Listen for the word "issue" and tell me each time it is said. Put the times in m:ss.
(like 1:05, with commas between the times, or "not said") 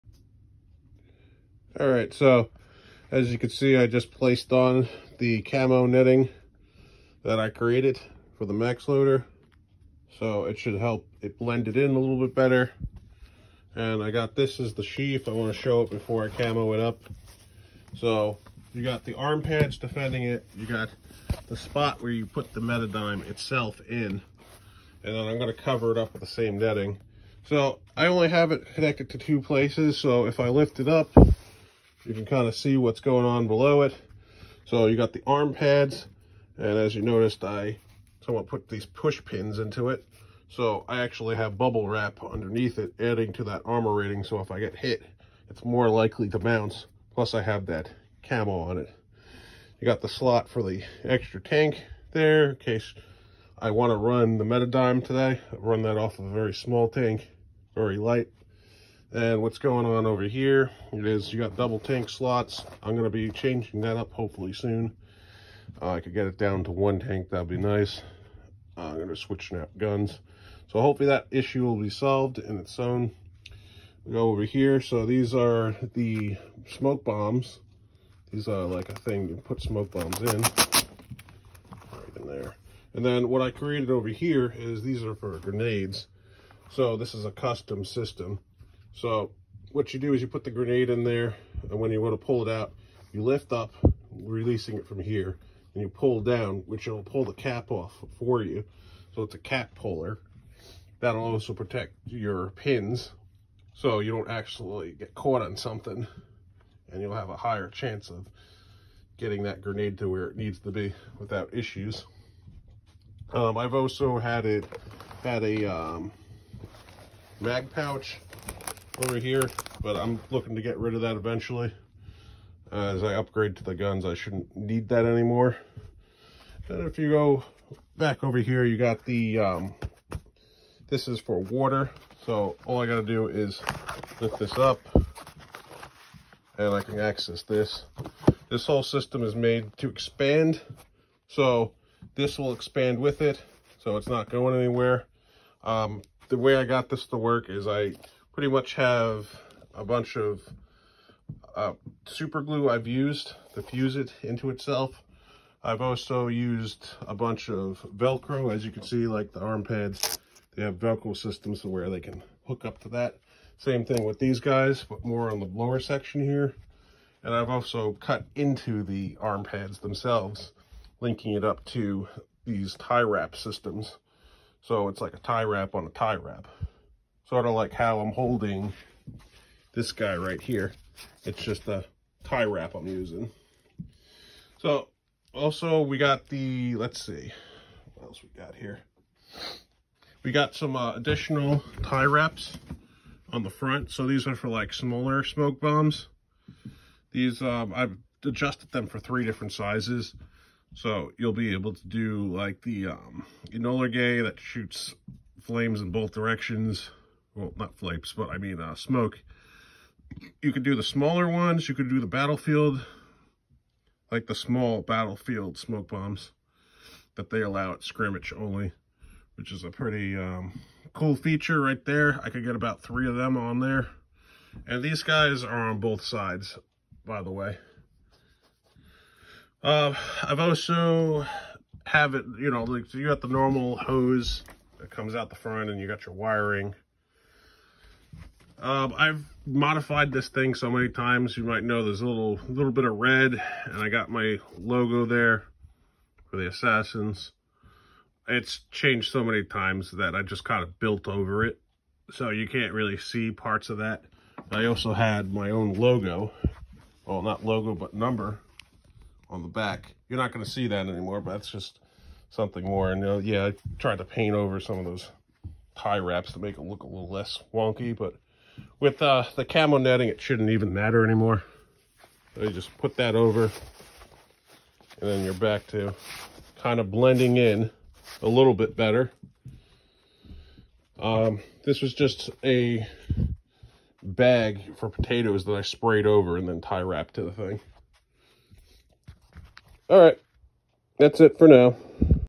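1:11, 1:51.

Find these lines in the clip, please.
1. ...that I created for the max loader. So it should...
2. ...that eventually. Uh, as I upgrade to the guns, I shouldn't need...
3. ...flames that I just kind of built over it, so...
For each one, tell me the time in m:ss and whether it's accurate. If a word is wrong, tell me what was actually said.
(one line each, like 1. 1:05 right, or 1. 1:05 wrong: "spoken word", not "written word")
1. 0:07 right
2. 2:01 right
3. 4:09 wrong: "times", not "flames".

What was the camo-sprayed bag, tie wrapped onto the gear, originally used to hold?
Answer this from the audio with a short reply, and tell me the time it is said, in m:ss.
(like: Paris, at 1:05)
Potatoes, at 4:44.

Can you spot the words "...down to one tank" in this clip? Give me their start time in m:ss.
1:06.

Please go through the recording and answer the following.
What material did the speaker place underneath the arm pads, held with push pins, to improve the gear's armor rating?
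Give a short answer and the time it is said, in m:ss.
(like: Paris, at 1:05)
Bubble wrap, at 0:41.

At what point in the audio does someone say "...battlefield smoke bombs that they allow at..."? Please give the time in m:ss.
3:34.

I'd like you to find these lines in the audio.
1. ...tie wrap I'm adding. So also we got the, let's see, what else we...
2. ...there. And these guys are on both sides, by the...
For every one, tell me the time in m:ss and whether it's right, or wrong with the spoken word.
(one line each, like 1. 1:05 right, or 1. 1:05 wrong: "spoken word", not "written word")
1. 3:02 wrong: "using", not "adding"
2. 3:43 right.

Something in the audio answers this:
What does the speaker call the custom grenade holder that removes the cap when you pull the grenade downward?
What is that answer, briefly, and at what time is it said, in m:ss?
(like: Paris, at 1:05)
Cap puller, at 1:39.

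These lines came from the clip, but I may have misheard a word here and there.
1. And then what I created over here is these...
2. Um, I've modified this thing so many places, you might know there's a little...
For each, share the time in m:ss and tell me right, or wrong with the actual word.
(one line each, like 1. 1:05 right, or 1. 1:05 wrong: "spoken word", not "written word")
1. 1:22 right
2. 3:58 wrong: "times", not "places".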